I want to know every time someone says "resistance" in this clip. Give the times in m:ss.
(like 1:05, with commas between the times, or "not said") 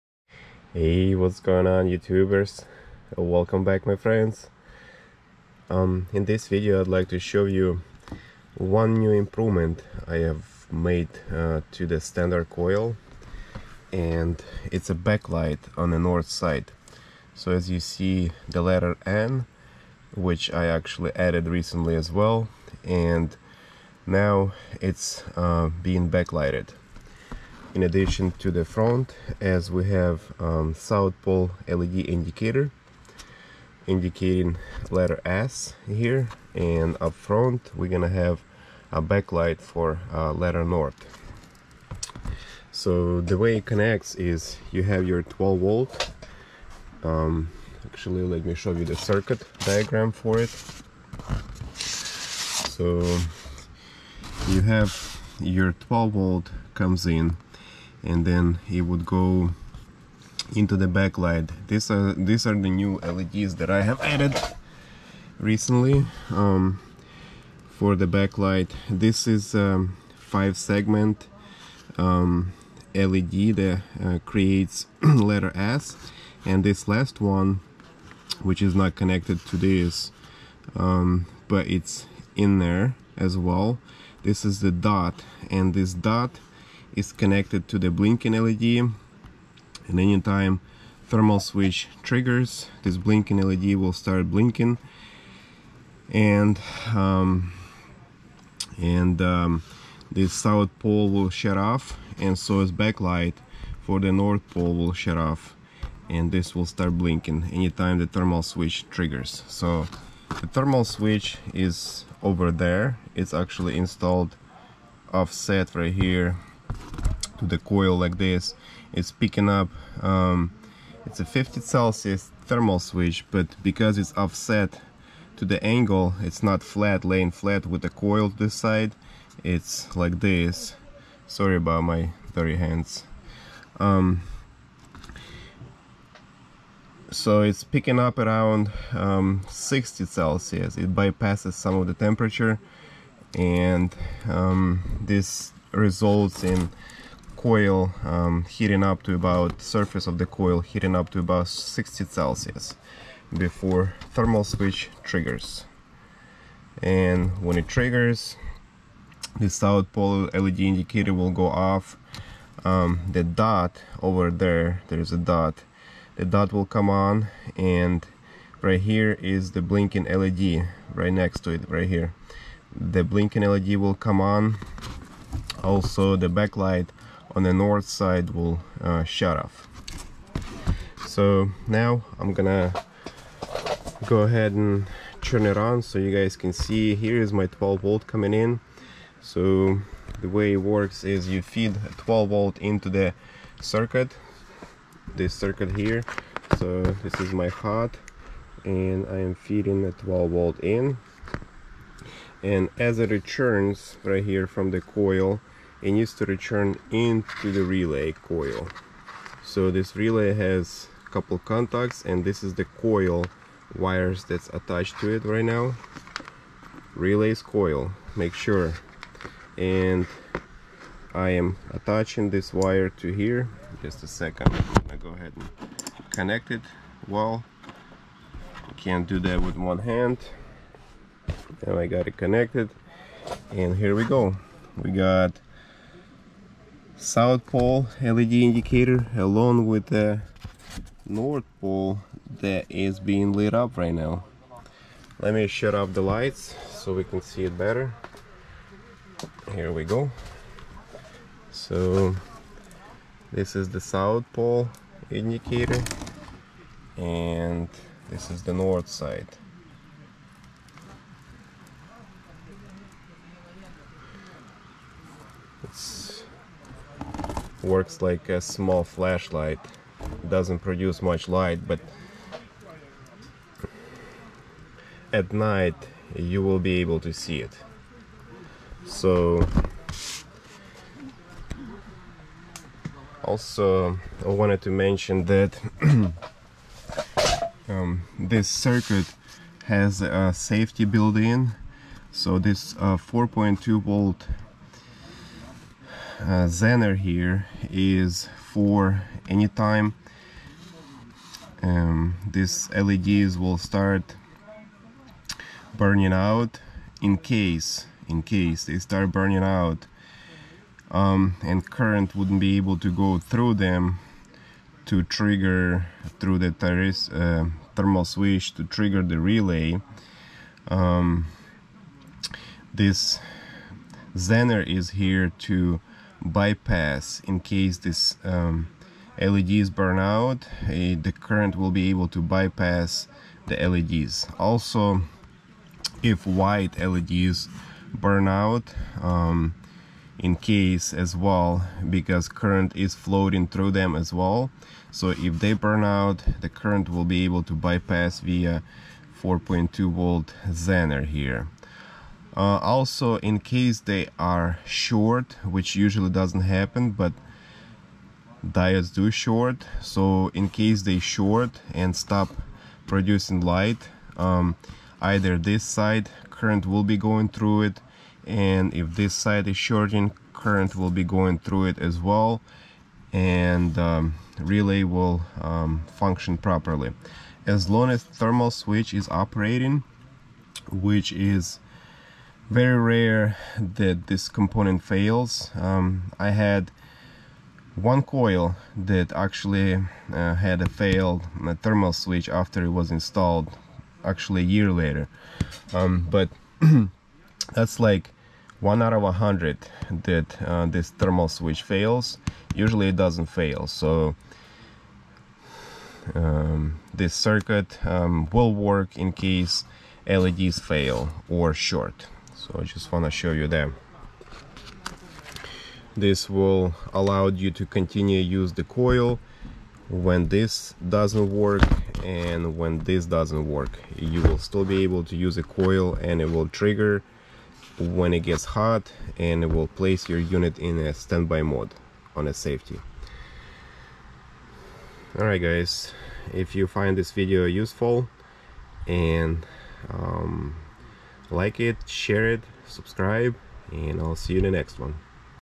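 not said.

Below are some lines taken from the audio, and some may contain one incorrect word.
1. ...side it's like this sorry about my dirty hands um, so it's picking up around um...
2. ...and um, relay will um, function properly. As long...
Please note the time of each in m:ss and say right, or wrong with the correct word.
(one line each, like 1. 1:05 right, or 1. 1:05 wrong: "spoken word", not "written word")
1. 2:08 right
2. 6:13 right.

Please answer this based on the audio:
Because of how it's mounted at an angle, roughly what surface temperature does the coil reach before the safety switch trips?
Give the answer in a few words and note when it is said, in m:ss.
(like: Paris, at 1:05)
60 Celsius, at 2:31.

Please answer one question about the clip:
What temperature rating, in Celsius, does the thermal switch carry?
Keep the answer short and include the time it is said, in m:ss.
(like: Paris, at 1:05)
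50 Celsius, at 2:01.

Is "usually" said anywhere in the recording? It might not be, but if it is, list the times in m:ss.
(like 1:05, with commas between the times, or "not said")
5:55, 6:42.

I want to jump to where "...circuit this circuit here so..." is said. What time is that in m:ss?
3:13.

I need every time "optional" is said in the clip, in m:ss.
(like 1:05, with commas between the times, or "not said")
not said.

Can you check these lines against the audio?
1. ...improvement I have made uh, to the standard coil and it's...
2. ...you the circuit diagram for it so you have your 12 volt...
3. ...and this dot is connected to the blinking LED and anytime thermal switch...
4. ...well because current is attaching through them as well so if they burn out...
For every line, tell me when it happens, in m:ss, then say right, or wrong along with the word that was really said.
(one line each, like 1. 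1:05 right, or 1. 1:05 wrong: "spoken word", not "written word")
1. 0:09 right
2. 0:48 right
3. 1:25 right
4. 5:41 wrong: "floating", not "attaching".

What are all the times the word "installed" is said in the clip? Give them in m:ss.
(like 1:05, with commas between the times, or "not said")
1:53, 6:32.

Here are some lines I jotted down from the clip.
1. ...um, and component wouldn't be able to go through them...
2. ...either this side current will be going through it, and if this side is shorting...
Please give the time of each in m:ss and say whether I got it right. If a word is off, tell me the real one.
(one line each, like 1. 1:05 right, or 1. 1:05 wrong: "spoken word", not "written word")
1. 5:10 wrong: "current", not "component"
2. 6:05 right.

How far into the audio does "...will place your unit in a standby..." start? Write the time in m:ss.
7:09.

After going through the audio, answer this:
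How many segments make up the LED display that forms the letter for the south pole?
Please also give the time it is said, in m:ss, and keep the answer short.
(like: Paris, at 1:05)
5, at 1:10.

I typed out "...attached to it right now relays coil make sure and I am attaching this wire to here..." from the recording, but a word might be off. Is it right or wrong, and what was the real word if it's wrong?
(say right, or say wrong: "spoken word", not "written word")
right.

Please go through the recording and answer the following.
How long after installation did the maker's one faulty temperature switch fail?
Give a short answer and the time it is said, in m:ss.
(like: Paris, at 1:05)
a year later, at 6:34.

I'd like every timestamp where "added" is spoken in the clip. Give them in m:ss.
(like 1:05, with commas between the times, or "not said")
0:21, 1:04.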